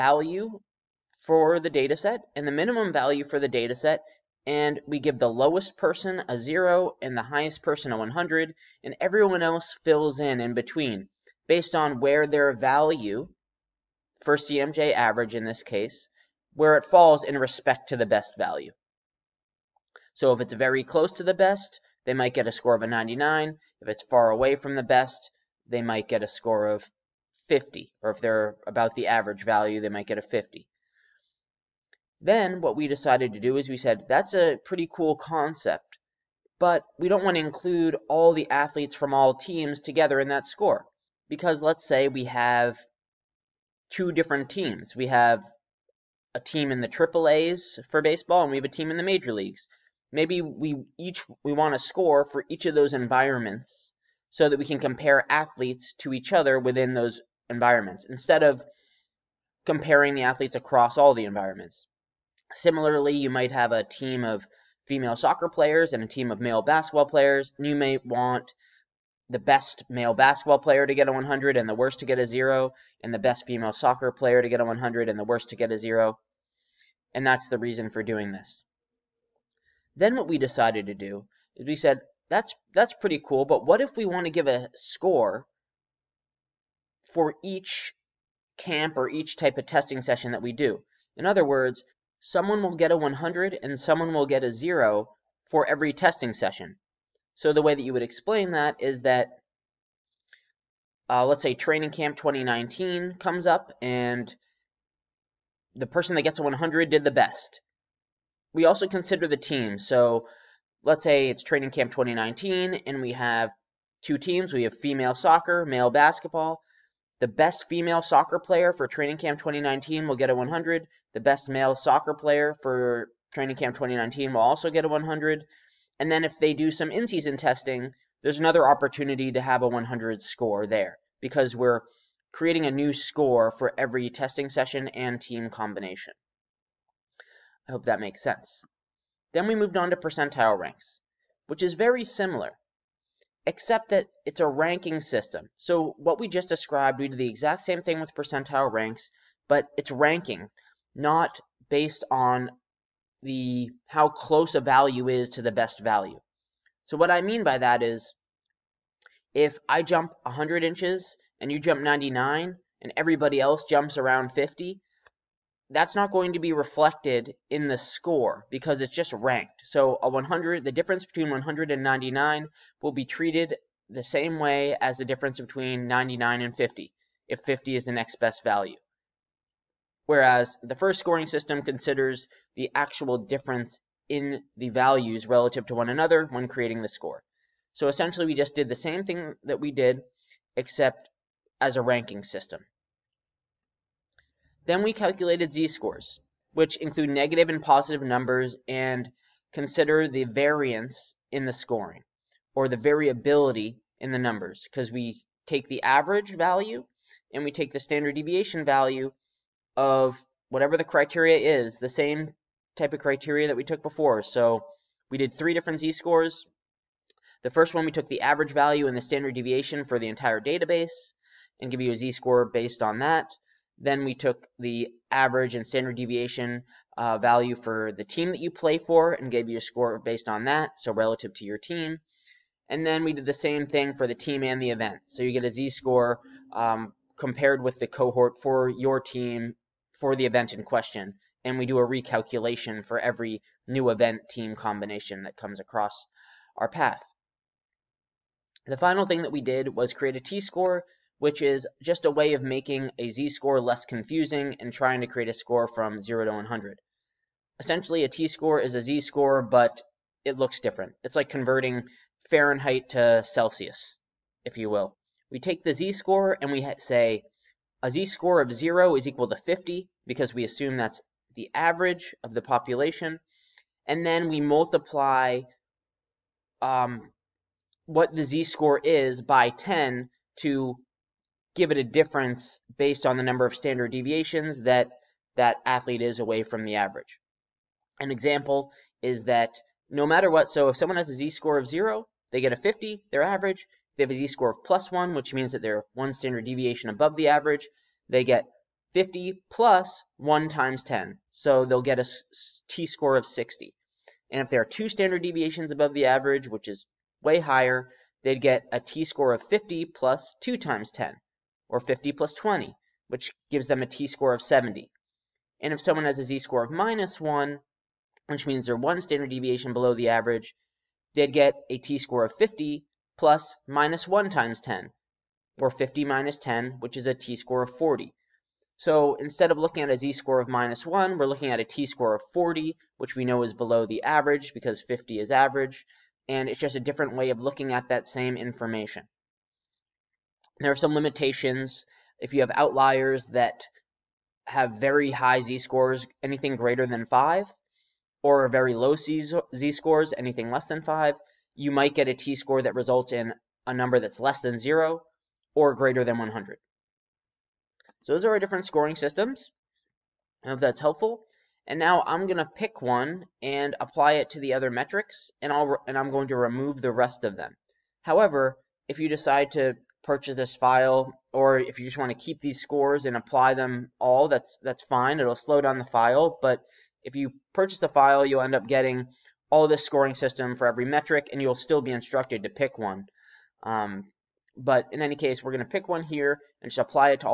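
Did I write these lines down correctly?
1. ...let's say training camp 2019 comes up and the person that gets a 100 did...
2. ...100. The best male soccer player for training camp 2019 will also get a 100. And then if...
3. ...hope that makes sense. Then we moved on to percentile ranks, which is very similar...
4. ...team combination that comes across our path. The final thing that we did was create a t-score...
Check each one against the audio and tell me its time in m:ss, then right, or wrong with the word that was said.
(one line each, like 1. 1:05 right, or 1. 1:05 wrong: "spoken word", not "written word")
1. 1:41 right
2. 2:00 right
3. 2:17 right
4. 4:04 right.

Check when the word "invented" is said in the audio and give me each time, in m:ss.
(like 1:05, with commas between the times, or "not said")
not said.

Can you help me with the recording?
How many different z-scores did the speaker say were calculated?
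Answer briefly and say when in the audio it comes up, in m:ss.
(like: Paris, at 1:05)
3, at 3:35.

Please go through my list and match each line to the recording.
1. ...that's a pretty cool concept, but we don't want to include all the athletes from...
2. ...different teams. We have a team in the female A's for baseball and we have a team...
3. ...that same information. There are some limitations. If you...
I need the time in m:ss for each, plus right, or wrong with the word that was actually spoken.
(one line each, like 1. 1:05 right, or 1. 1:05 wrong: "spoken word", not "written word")
1. 0:34 right
2. 0:44 wrong: "triple", not "female"
3. 5:37 right.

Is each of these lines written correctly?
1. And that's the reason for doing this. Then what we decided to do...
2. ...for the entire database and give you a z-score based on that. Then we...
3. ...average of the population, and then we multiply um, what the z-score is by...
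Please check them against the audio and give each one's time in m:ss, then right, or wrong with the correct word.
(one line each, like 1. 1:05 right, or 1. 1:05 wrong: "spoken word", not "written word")
1. 1:17 right
2. 3:39 right
3. 4:31 right.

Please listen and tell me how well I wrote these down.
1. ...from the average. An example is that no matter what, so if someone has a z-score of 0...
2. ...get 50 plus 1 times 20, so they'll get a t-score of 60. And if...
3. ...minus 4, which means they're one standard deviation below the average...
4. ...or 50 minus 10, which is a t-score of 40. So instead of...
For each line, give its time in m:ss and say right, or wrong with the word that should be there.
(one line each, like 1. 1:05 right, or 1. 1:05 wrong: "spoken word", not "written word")
1. 4:46 right
2. 4:58 wrong: "10", not "20"
3. 5:16 wrong: "1", not "4"
4. 5:25 right.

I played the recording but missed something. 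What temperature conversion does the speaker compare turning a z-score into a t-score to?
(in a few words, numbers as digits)
Fahrenheit to Celsius.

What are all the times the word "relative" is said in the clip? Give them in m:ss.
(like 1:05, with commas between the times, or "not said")
3:05, 3:50.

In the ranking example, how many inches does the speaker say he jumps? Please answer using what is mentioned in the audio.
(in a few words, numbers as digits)
100.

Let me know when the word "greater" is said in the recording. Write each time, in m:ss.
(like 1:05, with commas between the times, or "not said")
5:46, 5:55.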